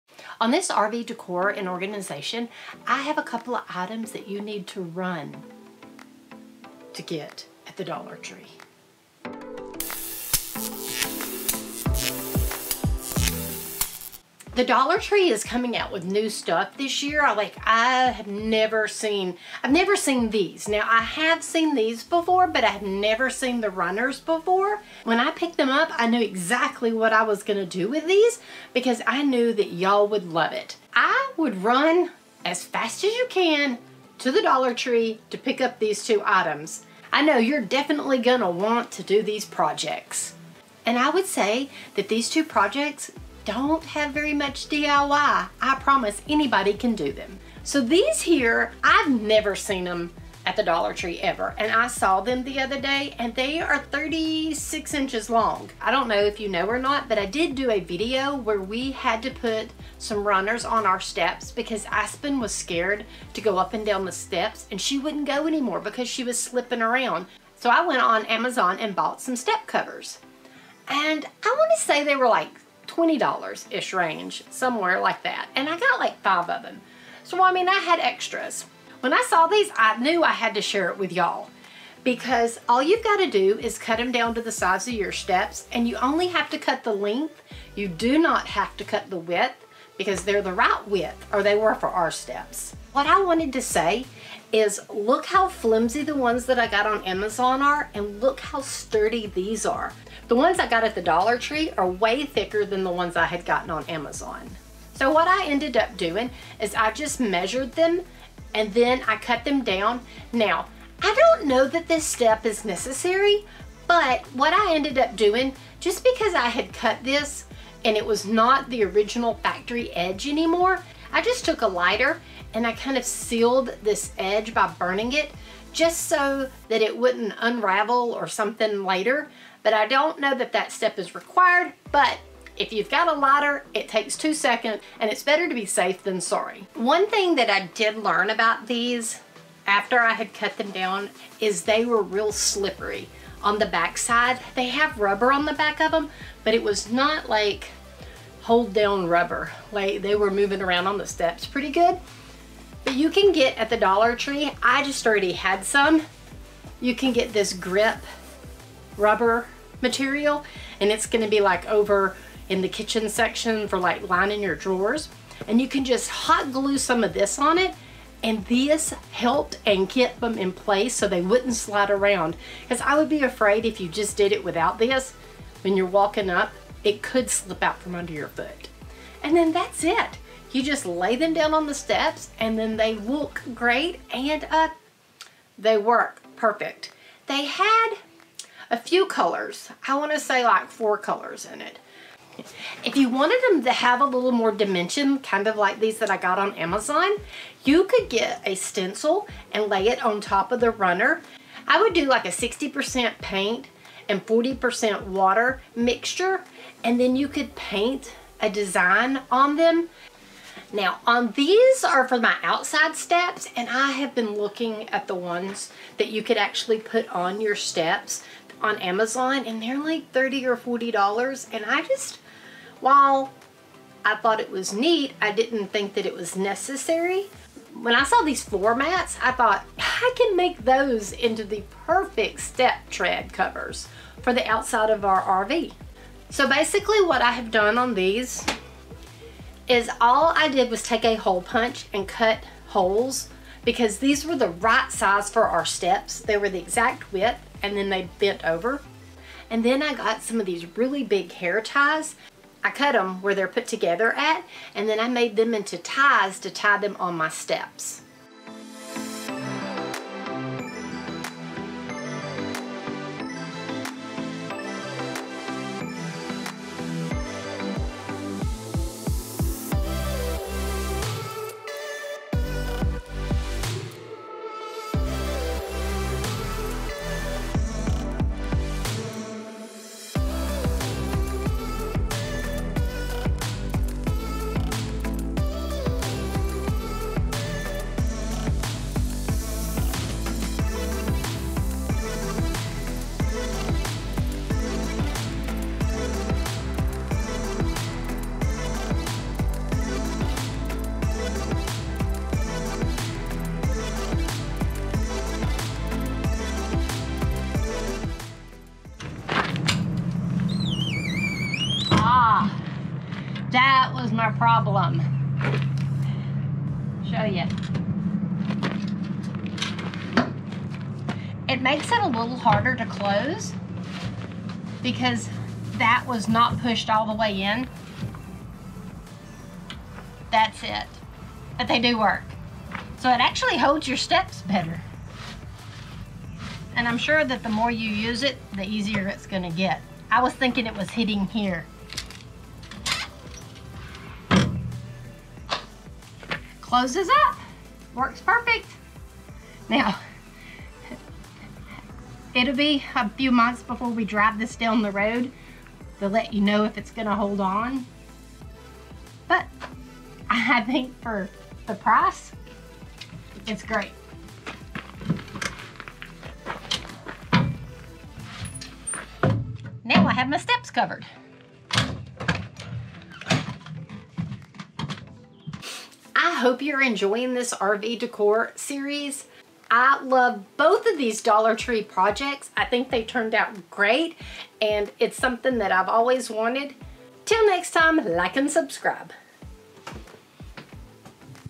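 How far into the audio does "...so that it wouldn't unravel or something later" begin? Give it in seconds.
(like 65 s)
126 s.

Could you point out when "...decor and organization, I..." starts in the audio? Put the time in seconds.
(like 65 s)
1 s.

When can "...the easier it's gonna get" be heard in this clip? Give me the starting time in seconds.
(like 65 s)
338 s.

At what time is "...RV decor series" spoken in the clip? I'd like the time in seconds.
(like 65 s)
377 s.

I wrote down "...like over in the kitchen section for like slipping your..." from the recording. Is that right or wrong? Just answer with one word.
wrong.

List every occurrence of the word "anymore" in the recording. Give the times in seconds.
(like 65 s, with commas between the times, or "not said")
65 s, 120 s.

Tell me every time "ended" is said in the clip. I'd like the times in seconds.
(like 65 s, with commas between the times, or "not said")
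105 s, 114 s.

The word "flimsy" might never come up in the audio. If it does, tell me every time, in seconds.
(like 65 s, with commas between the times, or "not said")
95 s.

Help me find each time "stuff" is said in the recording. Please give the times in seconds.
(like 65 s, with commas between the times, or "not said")
16 s.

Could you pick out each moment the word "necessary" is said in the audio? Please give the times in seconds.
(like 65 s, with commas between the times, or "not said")
112 s, 226 s.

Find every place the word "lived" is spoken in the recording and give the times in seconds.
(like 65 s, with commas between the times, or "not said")
not said.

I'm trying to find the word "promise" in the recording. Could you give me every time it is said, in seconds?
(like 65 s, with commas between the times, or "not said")
45 s.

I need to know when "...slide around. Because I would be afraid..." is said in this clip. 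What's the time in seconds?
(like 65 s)
171 s.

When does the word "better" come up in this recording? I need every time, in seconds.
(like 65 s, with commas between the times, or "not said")
135 s, 334 s.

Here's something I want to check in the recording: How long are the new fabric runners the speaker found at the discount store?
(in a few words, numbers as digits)
36 inches.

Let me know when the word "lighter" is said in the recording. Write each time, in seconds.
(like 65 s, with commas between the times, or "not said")
121 s, 133 s.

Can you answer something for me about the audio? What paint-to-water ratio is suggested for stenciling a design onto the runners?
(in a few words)
60% paint, 40% water.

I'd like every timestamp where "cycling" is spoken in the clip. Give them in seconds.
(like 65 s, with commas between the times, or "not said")
not said.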